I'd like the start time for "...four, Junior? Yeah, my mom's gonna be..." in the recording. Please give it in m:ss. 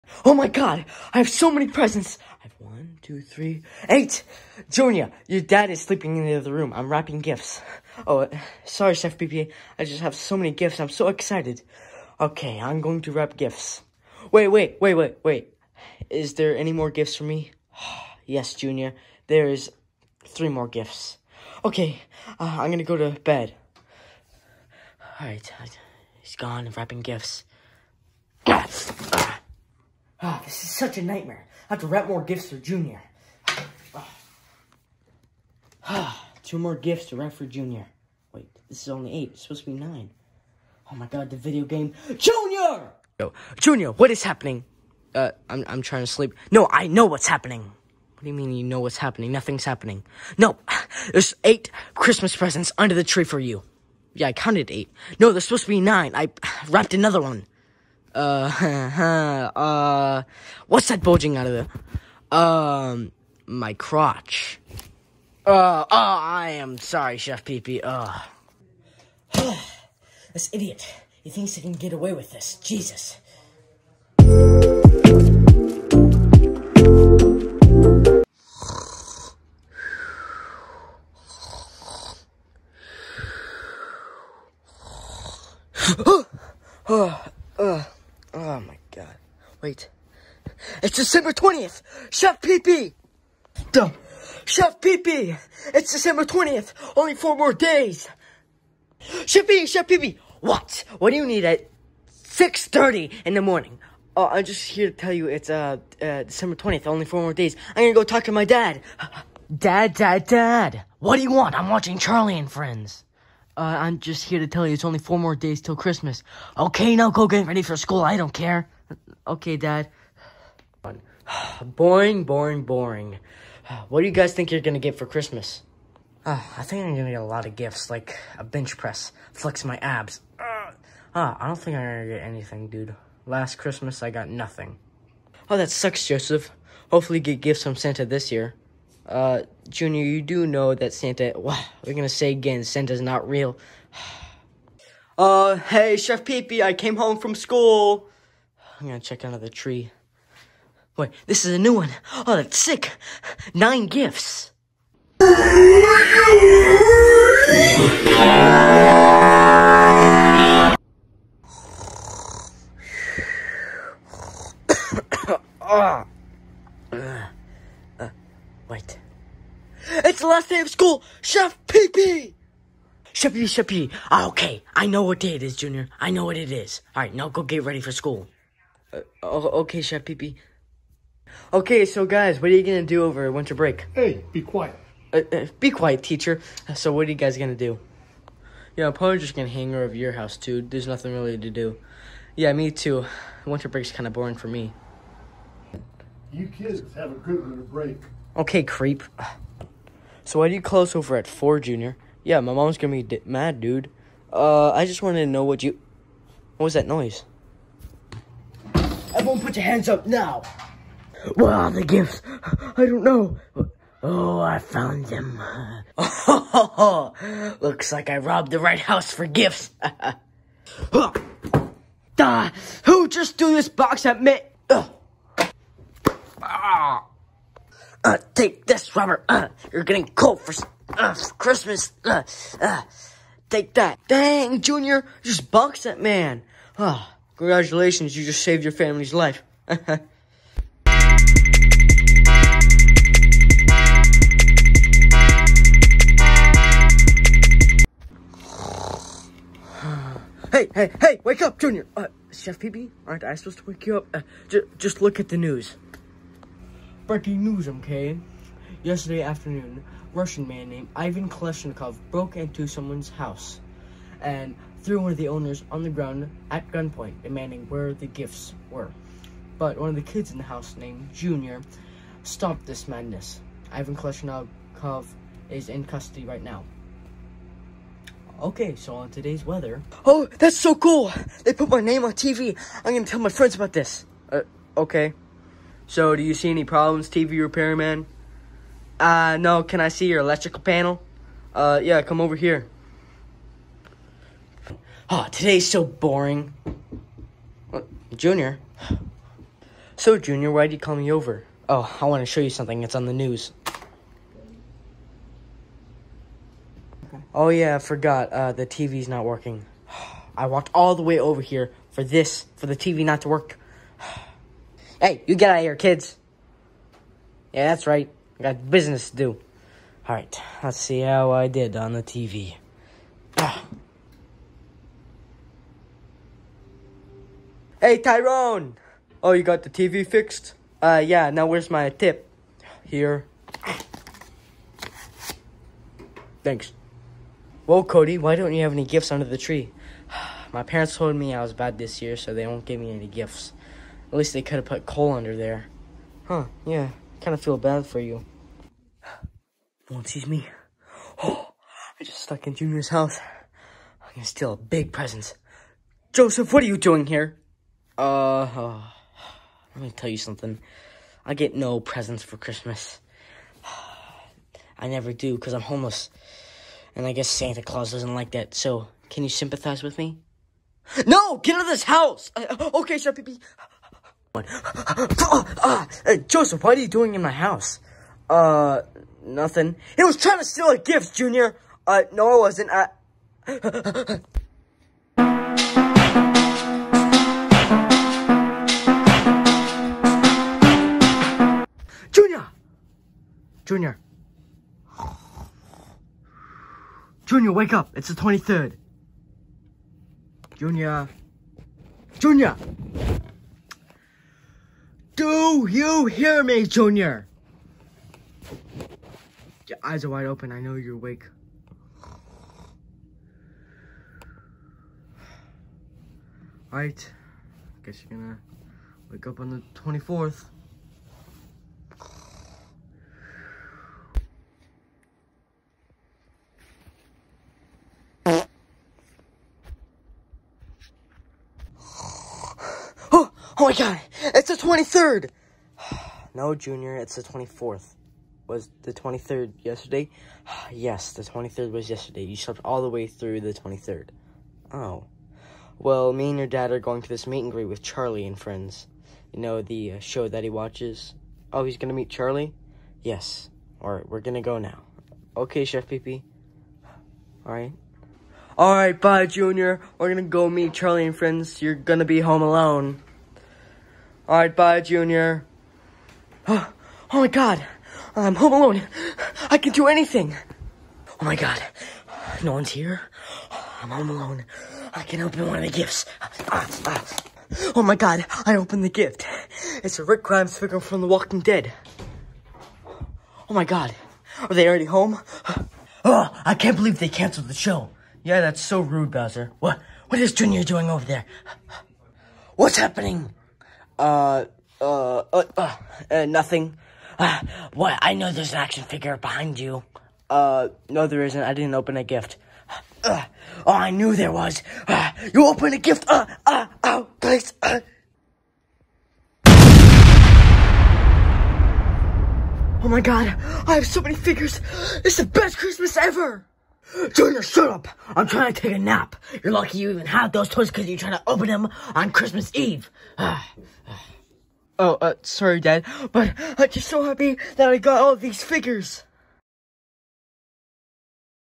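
3:21.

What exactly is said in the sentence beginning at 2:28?
I'm gonna check under the tree.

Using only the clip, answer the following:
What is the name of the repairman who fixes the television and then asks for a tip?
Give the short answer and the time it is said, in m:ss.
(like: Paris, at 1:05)
Tyrone, at 5:27.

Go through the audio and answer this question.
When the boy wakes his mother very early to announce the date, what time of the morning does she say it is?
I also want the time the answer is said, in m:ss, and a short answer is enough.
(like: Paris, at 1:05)
6:30, at 1:42.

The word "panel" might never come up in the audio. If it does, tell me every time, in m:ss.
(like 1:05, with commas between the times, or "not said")
4:50.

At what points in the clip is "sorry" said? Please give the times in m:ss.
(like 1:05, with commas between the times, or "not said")
0:08, 1:06, 8:45.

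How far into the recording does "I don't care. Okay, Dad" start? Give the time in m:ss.
1:58.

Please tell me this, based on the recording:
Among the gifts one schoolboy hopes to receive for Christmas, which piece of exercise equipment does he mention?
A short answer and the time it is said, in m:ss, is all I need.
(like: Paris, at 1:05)
Bench press, at 2:08.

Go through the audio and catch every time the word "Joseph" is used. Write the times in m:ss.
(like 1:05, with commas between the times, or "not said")
2:16, 5:56, 6:16.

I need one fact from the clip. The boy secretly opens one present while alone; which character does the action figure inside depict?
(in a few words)
Rick Grimes.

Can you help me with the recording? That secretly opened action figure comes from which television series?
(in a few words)
The Walking Dead.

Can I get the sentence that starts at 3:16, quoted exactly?
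You kids have a good winter break.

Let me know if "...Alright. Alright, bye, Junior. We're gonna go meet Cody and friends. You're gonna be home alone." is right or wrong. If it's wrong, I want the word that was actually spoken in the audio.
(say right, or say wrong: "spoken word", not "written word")
wrong: "Charlie", not "Cody".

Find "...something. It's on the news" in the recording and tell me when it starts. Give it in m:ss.
5:02.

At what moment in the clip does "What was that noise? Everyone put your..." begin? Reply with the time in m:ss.
3:26.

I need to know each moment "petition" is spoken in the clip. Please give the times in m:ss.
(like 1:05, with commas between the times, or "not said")
not said.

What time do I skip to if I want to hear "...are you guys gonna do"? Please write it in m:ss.
3:07.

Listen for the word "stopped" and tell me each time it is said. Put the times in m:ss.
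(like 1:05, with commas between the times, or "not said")
4:32.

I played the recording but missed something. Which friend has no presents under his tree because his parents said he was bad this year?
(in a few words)
Cody.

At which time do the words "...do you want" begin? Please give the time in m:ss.
1:51.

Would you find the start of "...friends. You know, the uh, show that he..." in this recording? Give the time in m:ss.
7:28.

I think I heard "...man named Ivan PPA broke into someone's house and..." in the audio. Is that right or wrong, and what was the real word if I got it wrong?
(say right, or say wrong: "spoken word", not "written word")
wrong: "Kleshnikov", not "PPA".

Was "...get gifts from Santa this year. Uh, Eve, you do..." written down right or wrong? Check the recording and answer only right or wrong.
wrong.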